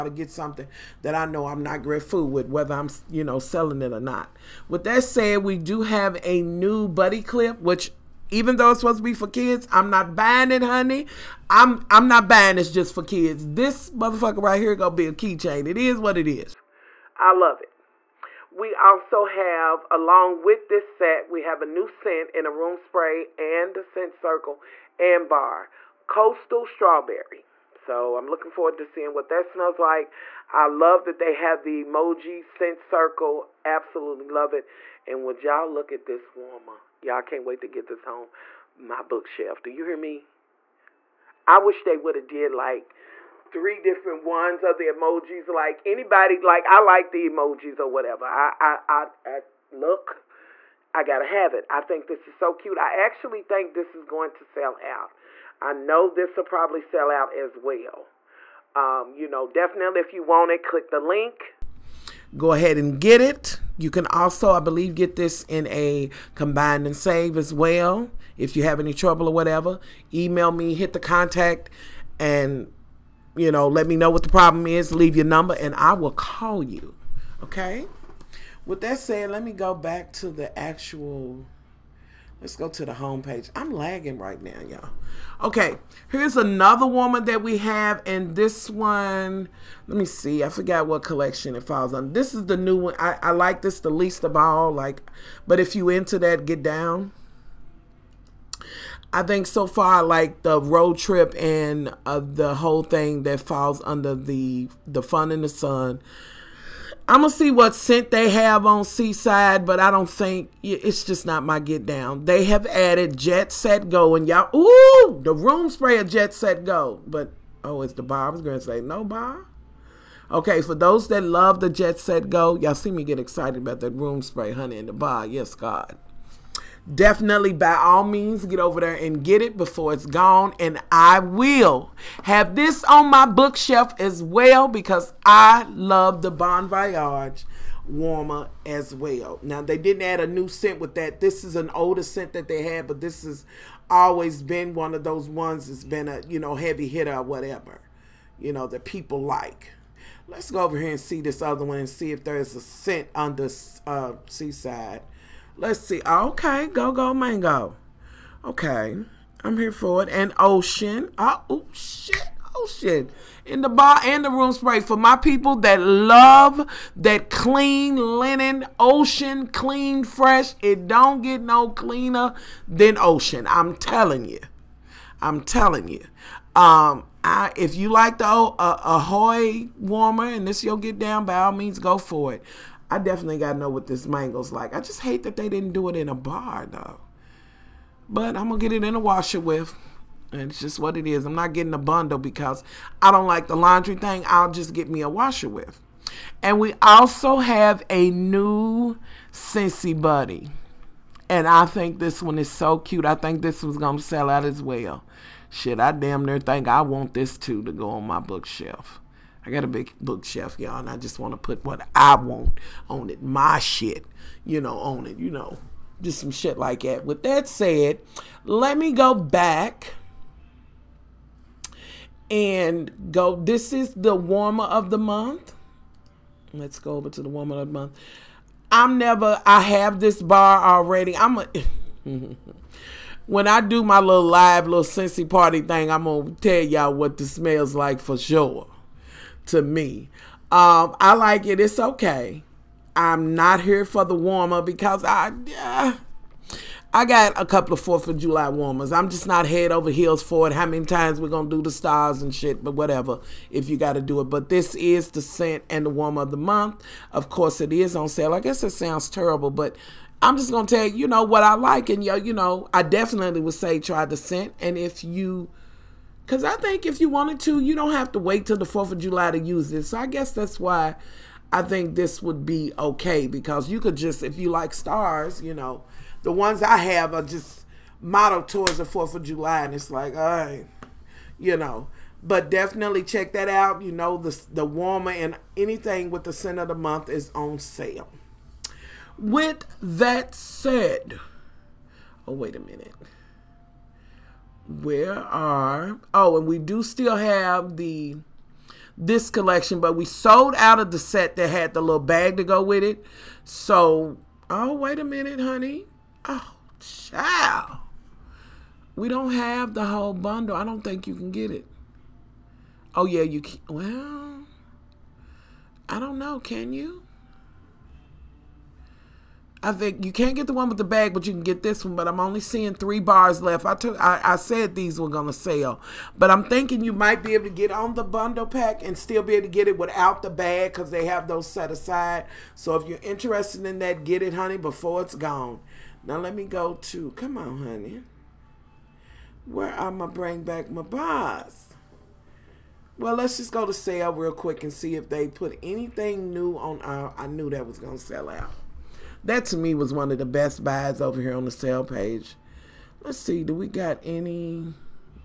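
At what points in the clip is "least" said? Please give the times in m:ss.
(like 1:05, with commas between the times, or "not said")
1:33.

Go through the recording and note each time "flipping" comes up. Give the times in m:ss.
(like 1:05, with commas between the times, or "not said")
not said.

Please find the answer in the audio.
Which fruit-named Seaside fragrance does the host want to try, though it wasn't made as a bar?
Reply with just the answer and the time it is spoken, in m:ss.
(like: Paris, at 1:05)
Go Go Mango, at 2:36.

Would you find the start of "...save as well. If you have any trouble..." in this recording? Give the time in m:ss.
1:06.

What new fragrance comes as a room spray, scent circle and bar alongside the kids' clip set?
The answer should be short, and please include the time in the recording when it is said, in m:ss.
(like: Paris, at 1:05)
Coastal Strawberry, at 0:26.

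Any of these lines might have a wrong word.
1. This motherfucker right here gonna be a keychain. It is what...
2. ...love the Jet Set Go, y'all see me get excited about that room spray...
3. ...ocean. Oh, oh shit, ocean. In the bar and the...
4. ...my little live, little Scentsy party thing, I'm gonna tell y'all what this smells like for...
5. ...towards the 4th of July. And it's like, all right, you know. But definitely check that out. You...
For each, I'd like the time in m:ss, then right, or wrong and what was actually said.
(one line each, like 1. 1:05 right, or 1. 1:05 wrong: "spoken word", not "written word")
1. 0:13 right
2. 2:01 right
3. 2:40 right
4. 3:53 right
5. 4:38 right.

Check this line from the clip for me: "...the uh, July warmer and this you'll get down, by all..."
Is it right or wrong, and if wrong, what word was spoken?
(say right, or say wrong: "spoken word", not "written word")
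wrong: "Ahoy", not "July".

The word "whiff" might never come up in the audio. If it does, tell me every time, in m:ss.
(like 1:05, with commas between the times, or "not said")
3:09, 3:15.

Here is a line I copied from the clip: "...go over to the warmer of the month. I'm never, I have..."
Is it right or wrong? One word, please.
right.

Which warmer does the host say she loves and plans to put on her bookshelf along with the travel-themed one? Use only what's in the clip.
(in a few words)
Bon Voyage.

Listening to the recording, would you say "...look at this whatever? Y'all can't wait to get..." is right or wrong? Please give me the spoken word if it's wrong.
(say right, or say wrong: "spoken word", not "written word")
wrong: "warmer", not "whatever".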